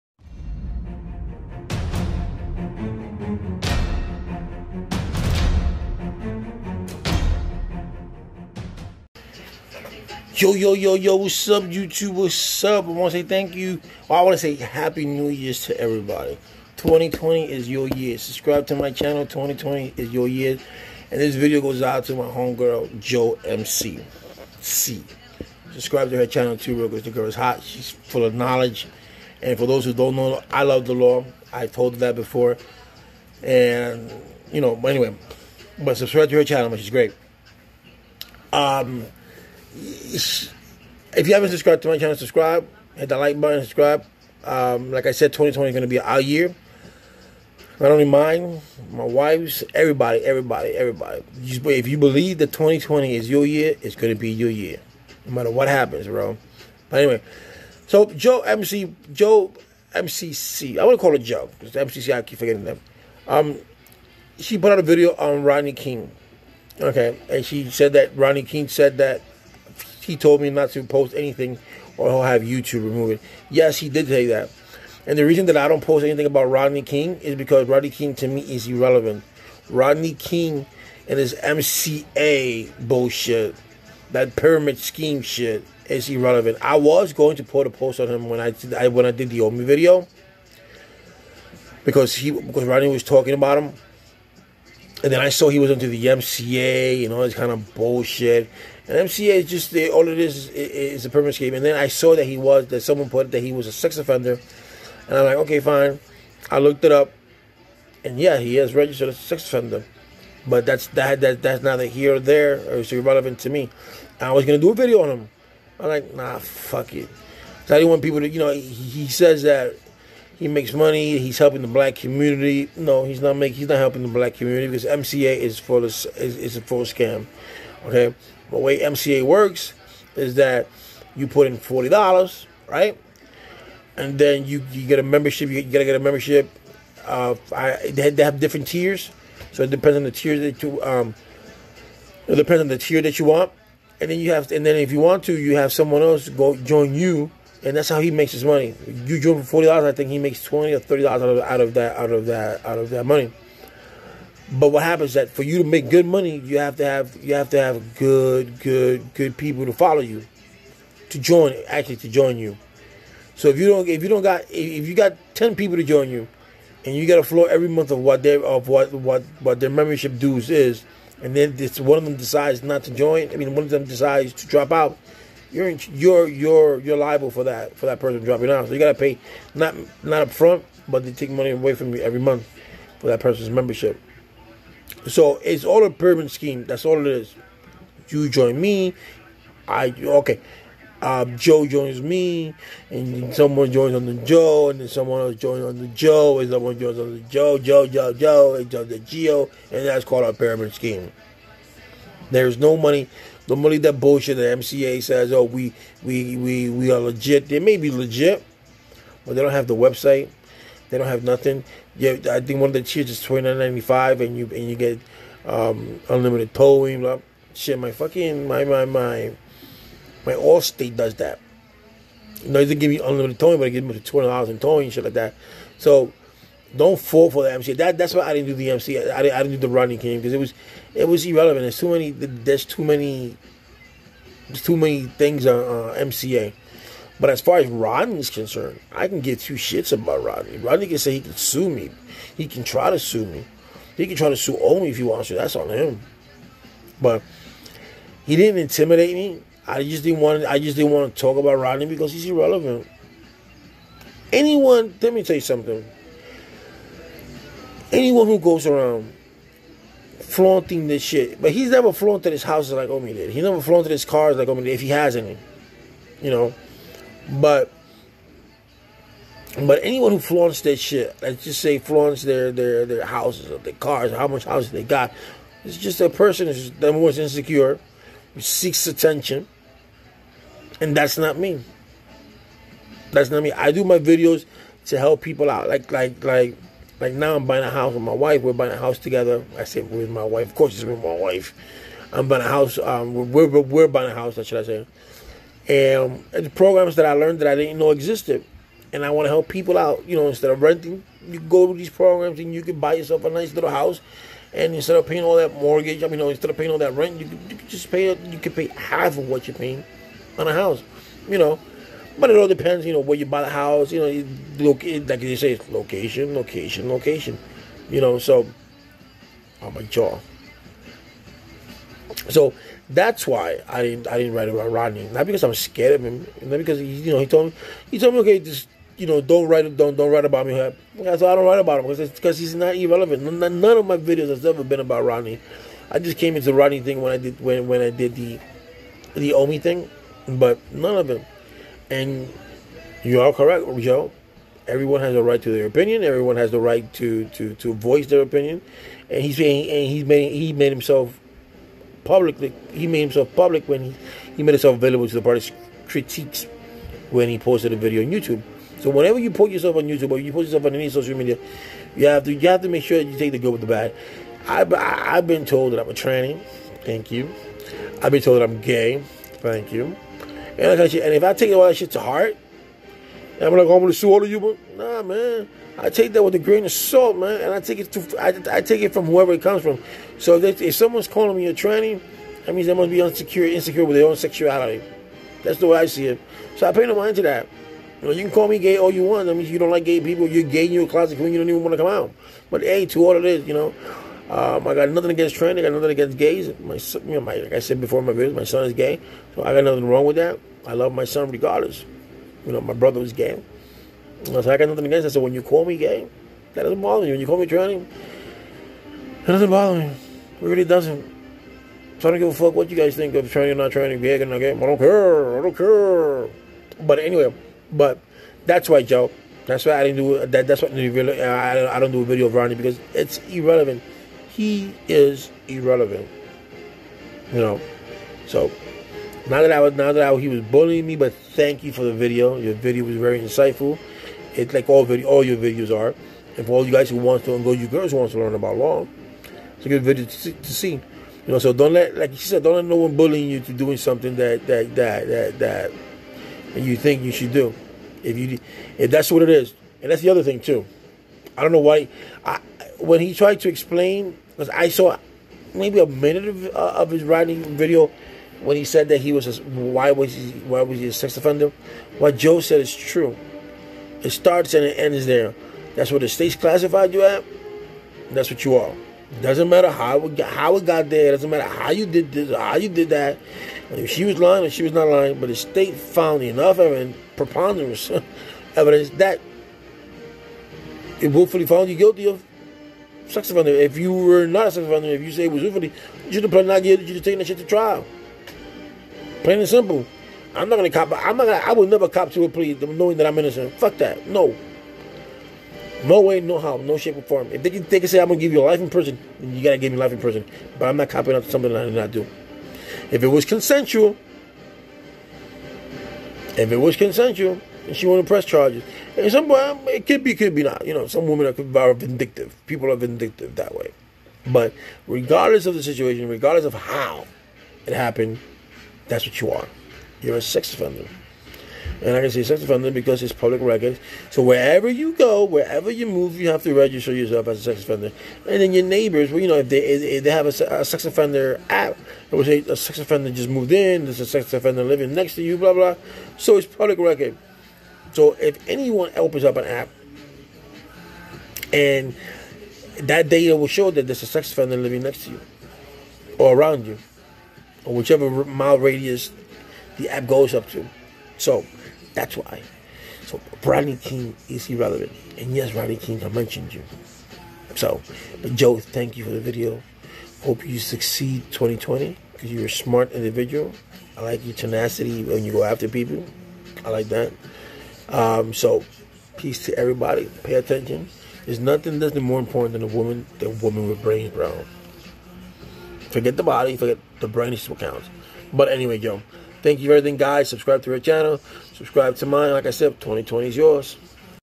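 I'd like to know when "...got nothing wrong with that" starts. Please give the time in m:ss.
6:39.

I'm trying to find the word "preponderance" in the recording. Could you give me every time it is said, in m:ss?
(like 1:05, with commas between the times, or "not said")
7:57.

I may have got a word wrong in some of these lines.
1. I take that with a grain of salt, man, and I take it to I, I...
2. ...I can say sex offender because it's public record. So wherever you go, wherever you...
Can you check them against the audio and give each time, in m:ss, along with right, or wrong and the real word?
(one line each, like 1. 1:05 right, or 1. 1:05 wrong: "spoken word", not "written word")
1. 6:15 right
2. 8:41 right.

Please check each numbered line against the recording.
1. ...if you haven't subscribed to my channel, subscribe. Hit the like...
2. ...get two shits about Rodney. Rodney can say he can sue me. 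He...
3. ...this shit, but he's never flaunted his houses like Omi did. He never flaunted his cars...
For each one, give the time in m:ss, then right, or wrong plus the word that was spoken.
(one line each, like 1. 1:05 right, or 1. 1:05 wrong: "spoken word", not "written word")
1. 0:39 right
2. 3:59 right
3. 4:20 right.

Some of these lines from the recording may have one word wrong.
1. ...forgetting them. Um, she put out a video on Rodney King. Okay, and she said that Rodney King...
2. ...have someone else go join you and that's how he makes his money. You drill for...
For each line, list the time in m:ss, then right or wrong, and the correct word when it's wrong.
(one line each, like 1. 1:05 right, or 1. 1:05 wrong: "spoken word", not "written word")
1. 1:02 right
2. 2:25 right.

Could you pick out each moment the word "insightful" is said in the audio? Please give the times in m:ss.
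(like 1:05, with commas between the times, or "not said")
7:13.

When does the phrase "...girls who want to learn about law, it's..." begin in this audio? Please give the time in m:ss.
7:17.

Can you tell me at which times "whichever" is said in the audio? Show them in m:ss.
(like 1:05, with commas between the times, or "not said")
9:07.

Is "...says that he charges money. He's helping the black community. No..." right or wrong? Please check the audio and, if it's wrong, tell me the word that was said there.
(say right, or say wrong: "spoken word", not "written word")
wrong: "makes", not "charges".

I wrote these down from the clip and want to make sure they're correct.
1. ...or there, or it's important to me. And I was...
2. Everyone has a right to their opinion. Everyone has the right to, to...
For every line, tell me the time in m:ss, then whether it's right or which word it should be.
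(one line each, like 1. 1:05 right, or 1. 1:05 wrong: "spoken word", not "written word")
1. 1:52 wrong: "irrelevant", not "important"
2. 5:44 right.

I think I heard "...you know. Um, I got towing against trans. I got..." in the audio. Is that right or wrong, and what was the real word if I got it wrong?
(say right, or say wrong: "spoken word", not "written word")
wrong: "nothing", not "towing".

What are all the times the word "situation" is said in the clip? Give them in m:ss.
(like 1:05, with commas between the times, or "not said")
8:35.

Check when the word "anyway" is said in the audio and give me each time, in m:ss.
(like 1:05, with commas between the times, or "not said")
0:34, 0:56, 6:56, 9:38.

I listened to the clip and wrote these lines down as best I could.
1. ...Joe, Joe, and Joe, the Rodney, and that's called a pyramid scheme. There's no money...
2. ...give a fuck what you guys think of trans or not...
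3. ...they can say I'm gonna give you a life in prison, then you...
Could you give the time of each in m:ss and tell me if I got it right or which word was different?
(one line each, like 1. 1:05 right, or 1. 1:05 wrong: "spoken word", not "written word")
1. 3:17 wrong: "Geo", not "Rodney"
2. 6:52 right
3. 8:17 right.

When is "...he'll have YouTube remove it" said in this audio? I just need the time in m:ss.
1:12.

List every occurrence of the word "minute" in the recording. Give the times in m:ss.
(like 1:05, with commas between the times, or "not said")
7:35.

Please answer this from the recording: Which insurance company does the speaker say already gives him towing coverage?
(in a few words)
Allstate.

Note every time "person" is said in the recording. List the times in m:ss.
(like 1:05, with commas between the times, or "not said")
2:57, 3:03, 4:36.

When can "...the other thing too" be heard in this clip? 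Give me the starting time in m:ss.
7:30.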